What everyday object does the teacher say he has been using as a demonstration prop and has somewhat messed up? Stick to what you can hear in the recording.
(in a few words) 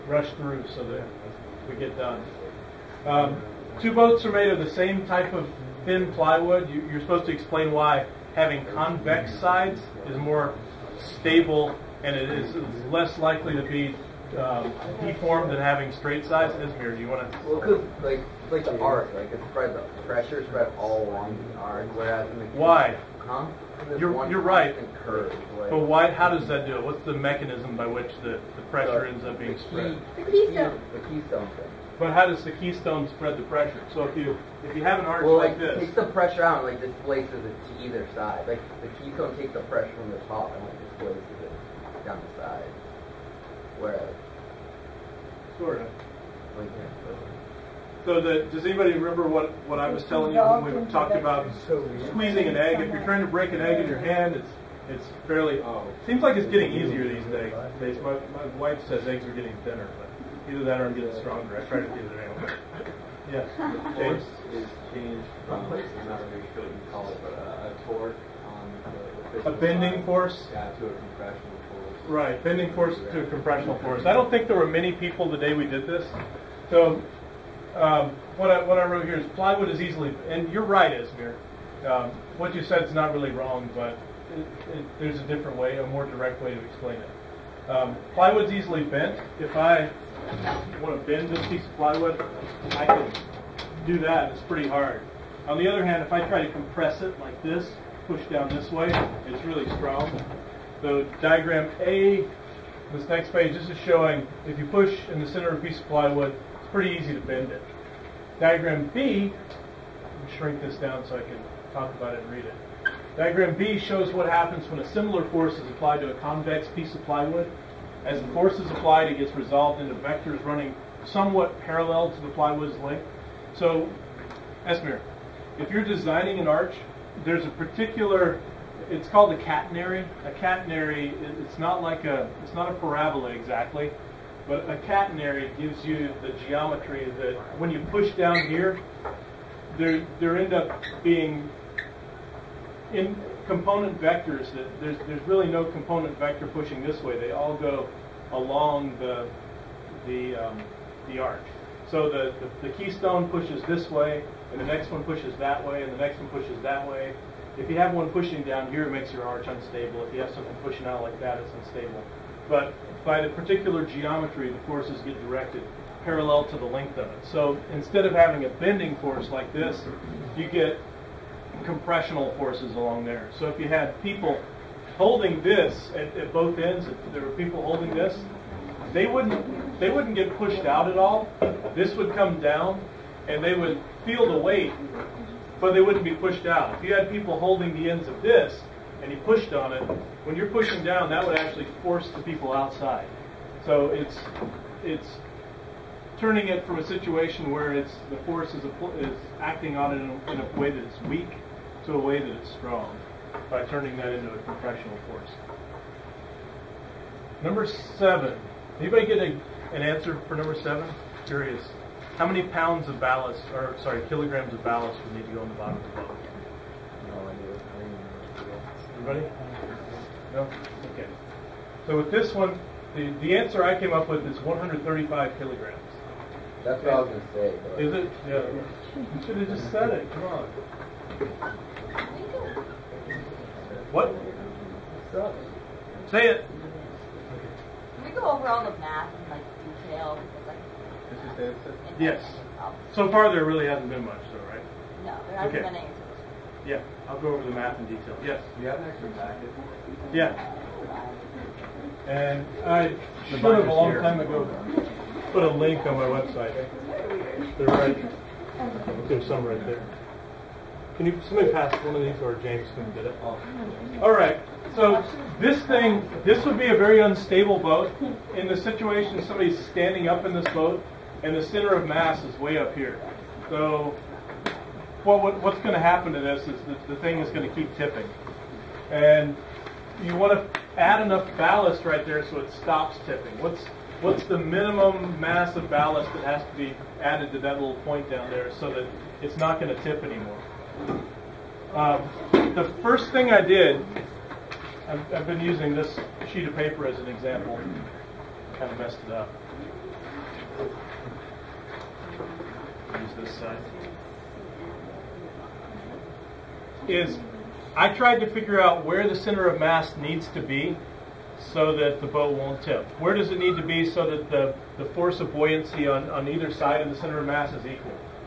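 Sheet of paper.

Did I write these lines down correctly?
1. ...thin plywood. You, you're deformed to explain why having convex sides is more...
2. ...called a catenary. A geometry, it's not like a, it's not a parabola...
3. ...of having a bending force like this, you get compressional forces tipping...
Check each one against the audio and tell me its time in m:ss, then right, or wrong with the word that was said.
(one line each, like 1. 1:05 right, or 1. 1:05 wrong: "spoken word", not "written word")
1. 0:05 wrong: "supposed", not "deformed"
2. 2:09 wrong: "catenary", not "geometry"
3. 2:48 wrong: "along", not "tipping".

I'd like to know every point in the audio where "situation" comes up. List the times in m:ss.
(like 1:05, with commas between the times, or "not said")
3:16, 4:28.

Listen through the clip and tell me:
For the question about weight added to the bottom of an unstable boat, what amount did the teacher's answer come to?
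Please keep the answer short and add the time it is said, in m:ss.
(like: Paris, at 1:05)
135 kilograms, at 3:44.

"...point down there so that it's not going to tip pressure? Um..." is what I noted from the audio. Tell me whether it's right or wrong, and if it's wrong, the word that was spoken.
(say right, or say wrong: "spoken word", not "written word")
wrong: "anymore", not "pressure".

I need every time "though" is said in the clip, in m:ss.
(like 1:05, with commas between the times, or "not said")
4:04.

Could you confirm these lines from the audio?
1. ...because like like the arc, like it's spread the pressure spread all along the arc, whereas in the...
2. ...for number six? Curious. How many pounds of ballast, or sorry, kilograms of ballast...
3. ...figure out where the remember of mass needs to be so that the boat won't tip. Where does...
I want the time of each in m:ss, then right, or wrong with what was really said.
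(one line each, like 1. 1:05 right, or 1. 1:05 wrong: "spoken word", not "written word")
1. 0:17 right
2. 3:30 wrong: "seven", not "six"
3. 5:08 wrong: "center", not "remember".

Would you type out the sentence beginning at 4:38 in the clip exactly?
And you want to add enough ballast right there so it stops tipping.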